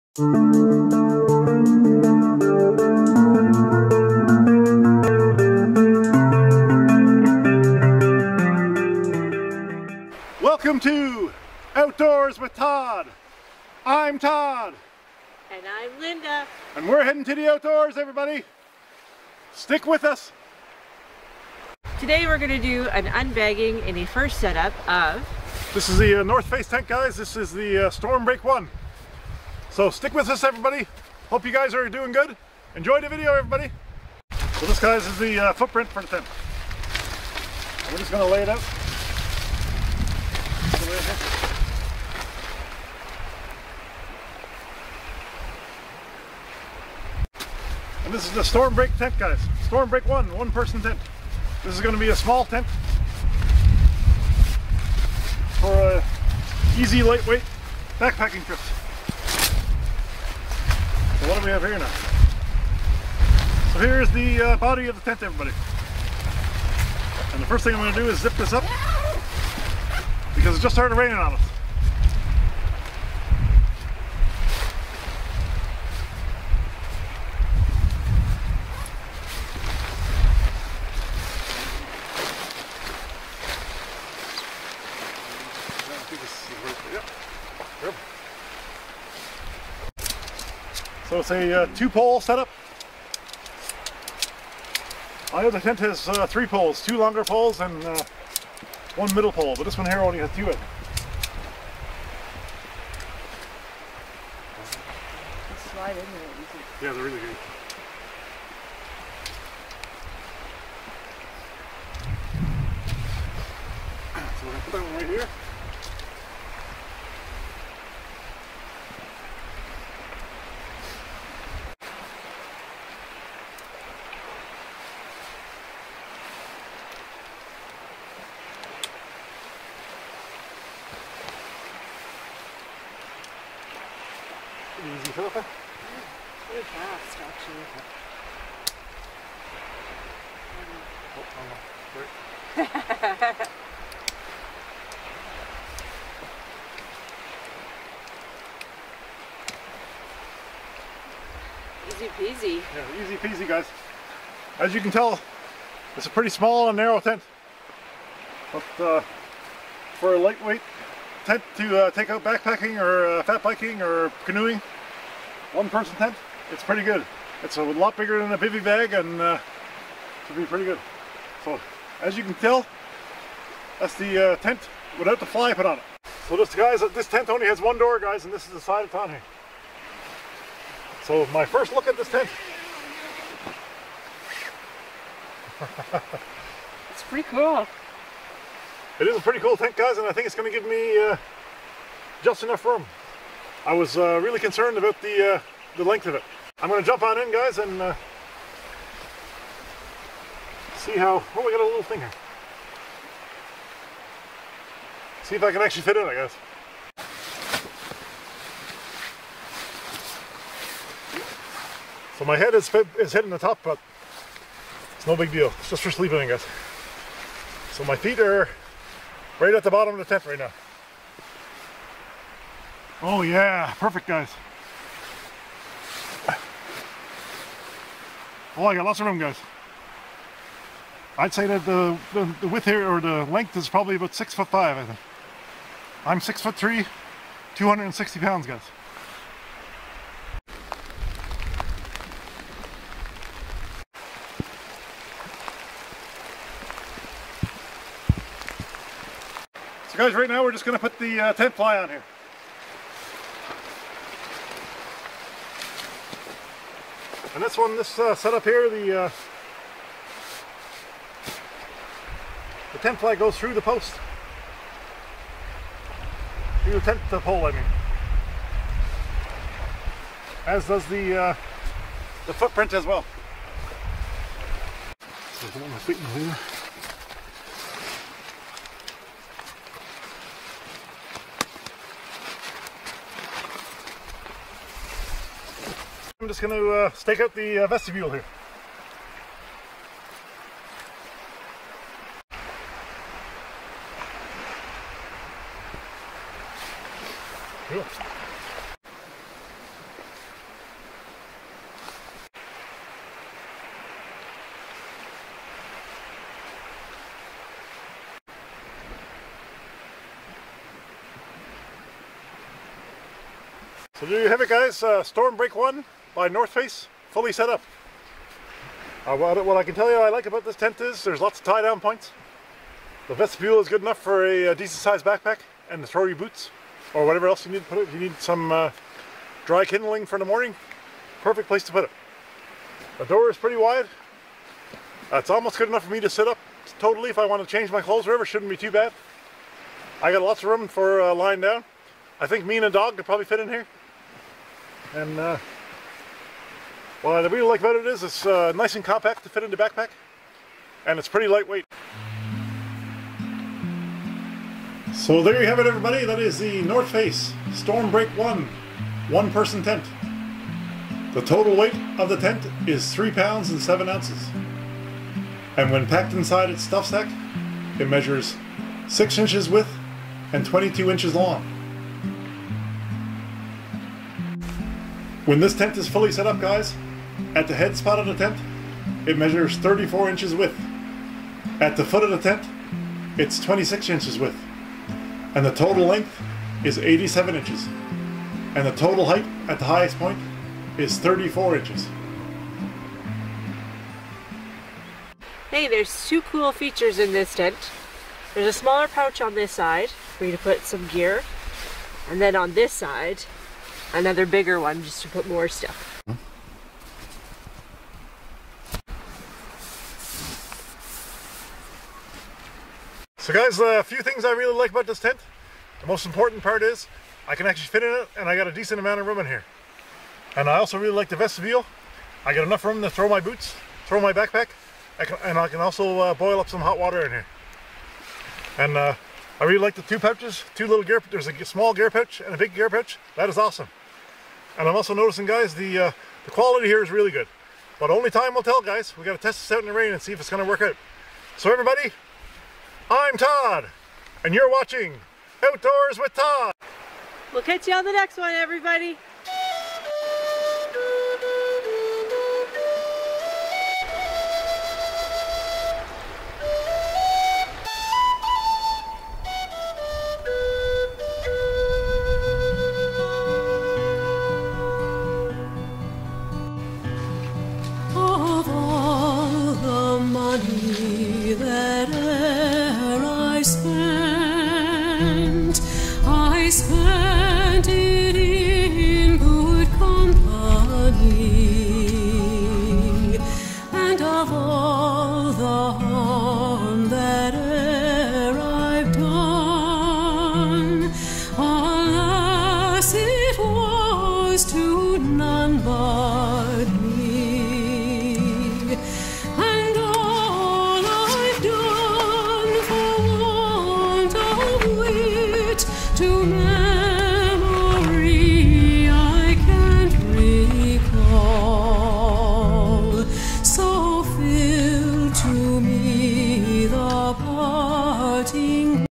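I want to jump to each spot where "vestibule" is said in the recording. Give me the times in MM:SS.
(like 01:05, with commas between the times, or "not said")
04:47, 05:23, 07:01.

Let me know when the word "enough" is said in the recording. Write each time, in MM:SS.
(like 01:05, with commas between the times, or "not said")
03:12, 05:23, 05:35, 07:02.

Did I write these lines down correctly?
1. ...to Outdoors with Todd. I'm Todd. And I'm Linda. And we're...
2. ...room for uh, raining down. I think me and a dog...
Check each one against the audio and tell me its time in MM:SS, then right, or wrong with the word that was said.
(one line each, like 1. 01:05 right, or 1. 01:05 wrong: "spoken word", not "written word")
1. 00:10 right
2. 05:40 wrong: "lying", not "raining".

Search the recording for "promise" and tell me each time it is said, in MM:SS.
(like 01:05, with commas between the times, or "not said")
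not said.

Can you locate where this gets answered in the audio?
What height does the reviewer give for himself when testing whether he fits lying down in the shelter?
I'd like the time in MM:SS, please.
03:56.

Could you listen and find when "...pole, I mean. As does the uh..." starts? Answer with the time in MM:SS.
04:27.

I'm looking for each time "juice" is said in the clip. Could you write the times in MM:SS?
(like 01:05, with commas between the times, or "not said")
not said.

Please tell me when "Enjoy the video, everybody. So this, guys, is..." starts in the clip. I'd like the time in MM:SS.
00:32.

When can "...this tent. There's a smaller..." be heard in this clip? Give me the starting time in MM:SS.
06:37.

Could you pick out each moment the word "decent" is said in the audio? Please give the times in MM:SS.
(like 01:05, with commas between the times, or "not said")
05:24, 06:58.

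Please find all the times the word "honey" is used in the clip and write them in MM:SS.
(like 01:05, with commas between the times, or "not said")
not said.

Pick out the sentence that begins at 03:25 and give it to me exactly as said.
See if I can actually fit in, I guess.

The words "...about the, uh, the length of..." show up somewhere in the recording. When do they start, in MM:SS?
03:14.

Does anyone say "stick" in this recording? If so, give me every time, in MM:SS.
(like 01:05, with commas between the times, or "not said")
00:19, 00:29.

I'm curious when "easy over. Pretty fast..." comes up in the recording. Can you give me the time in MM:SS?
02:14.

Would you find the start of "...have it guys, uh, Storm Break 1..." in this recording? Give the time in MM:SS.
05:14.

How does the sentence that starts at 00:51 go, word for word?
This is gonna be a small tent for a uh, easy, lightweight backpacking trip.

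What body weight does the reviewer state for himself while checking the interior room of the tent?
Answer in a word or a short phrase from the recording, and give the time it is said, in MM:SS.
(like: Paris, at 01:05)
260 pounds, at 03:57.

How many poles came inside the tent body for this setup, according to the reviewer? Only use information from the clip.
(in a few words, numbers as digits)
2.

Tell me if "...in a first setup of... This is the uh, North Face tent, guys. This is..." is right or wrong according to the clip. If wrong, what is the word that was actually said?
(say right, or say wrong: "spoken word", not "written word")
right.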